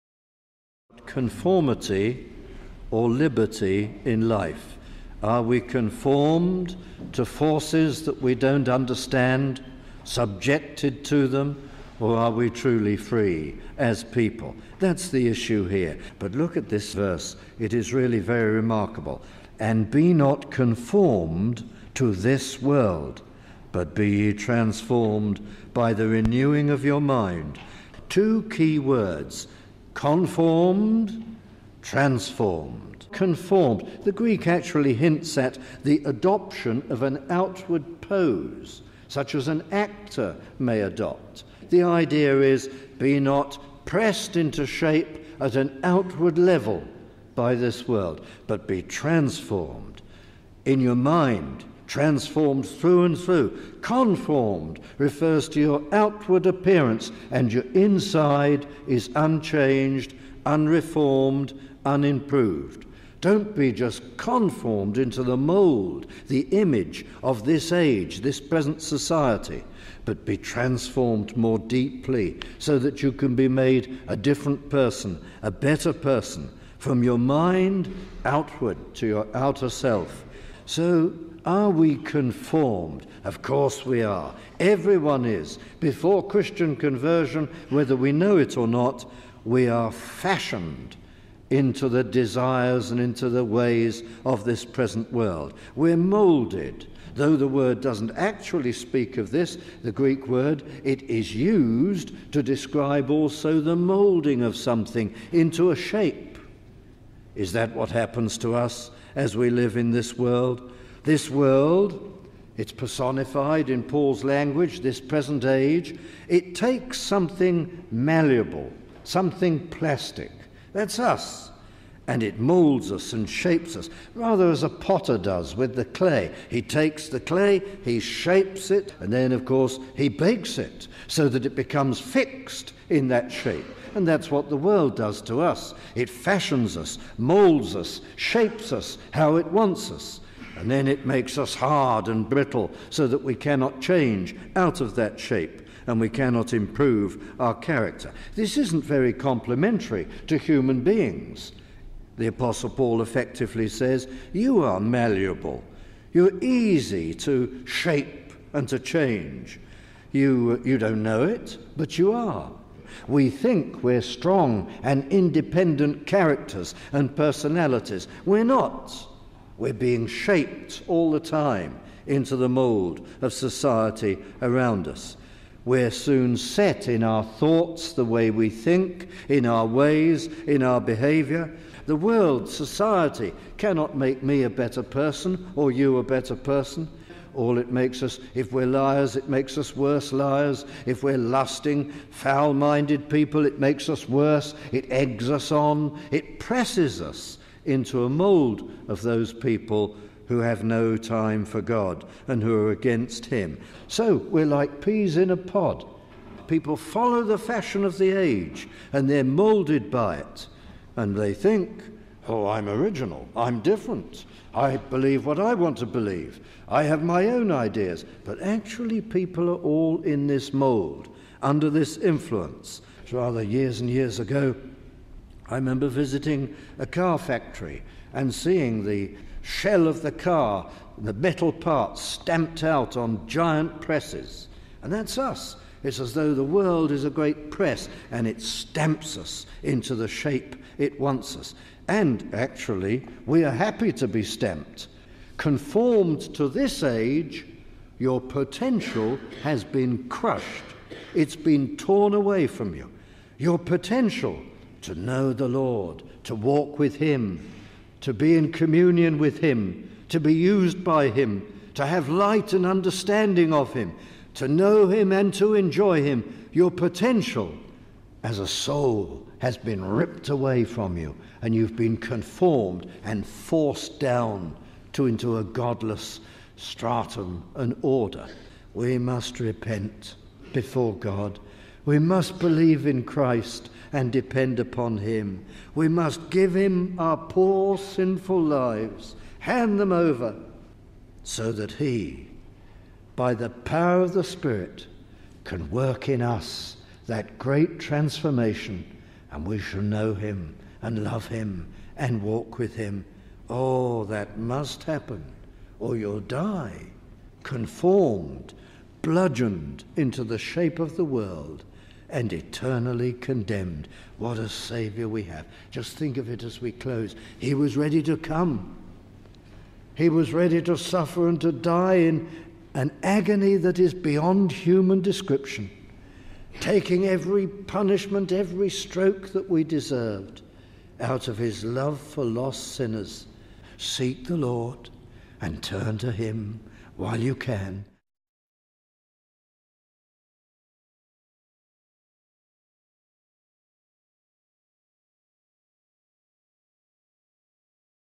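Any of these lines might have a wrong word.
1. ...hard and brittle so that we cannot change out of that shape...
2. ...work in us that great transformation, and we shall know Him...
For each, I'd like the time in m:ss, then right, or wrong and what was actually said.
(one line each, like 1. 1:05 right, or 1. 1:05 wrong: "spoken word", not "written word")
1. 2:21 right
2. 4:55 right.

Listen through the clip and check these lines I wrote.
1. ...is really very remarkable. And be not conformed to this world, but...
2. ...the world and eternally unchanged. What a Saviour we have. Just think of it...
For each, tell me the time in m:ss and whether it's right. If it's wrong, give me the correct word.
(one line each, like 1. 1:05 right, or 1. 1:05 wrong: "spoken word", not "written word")
1. 0:17 right
2. 5:10 wrong: "condemned", not "unchanged".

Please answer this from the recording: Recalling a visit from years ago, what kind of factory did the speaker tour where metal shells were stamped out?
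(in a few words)
A car factory.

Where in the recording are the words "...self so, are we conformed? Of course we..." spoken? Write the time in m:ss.
1:19.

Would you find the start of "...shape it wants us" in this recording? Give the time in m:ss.
4:00.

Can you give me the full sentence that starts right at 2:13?
And that's what the world does to us.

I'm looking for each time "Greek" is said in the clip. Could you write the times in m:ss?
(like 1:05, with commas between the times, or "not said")
0:34, 1:39.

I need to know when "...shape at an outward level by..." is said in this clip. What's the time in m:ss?
0:44.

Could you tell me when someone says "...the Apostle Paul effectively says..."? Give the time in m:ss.
2:32.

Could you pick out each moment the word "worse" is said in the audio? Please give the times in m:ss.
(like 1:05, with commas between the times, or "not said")
3:09, 3:14.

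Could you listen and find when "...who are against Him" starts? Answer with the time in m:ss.
3:22.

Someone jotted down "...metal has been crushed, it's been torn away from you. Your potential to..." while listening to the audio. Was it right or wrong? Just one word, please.
wrong.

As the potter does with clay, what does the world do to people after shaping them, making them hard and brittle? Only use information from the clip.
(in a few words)
Bakes it.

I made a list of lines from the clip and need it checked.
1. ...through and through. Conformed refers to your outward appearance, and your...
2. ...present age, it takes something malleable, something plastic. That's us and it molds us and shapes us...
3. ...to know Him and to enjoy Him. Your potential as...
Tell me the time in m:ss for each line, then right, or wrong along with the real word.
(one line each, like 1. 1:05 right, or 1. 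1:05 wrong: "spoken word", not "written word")
1. 0:52 right
2. 1:55 right
3. 4:24 right.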